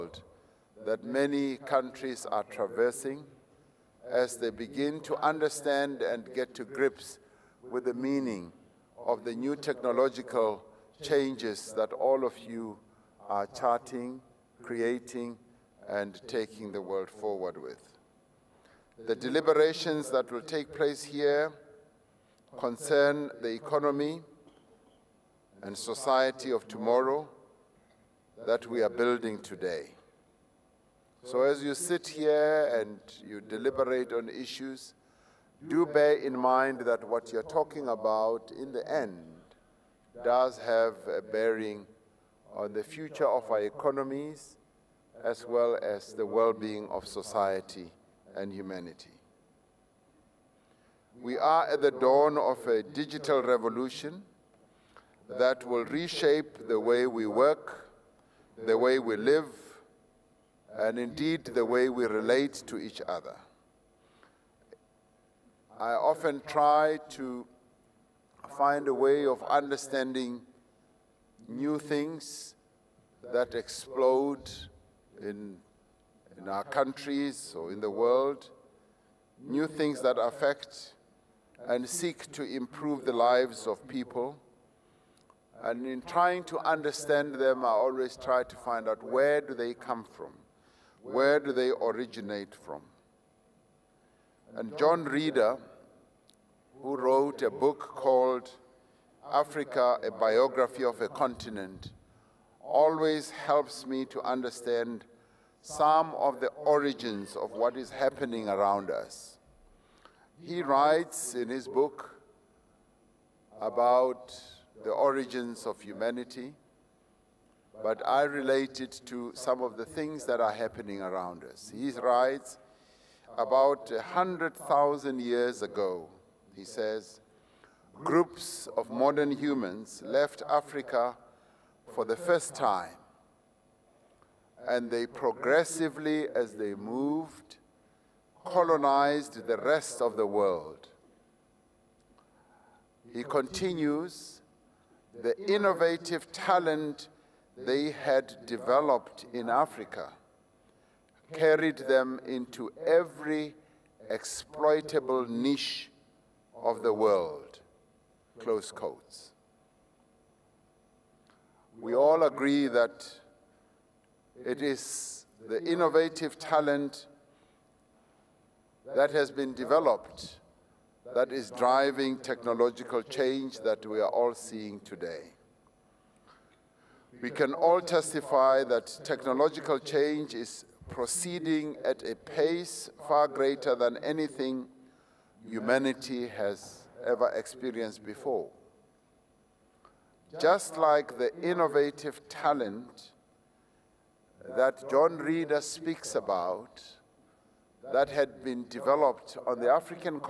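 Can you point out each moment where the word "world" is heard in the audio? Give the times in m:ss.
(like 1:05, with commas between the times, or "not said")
0:16, 1:17, 2:20, 2:36.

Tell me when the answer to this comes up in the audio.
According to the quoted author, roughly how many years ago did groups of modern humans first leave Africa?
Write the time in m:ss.
2:03.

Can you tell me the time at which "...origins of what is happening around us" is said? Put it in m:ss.
1:46.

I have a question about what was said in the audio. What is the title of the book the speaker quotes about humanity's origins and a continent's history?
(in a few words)
Africa, a Biography of a Continent.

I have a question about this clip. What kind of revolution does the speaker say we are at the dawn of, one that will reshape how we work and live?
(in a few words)
digital revolution.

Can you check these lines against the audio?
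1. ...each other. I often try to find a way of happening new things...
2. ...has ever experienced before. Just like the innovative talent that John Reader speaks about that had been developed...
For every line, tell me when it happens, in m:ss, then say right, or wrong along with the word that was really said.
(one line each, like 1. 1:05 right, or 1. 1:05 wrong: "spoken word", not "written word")
1. 1:02 wrong: "understanding", not "happening"
2. 3:06 right.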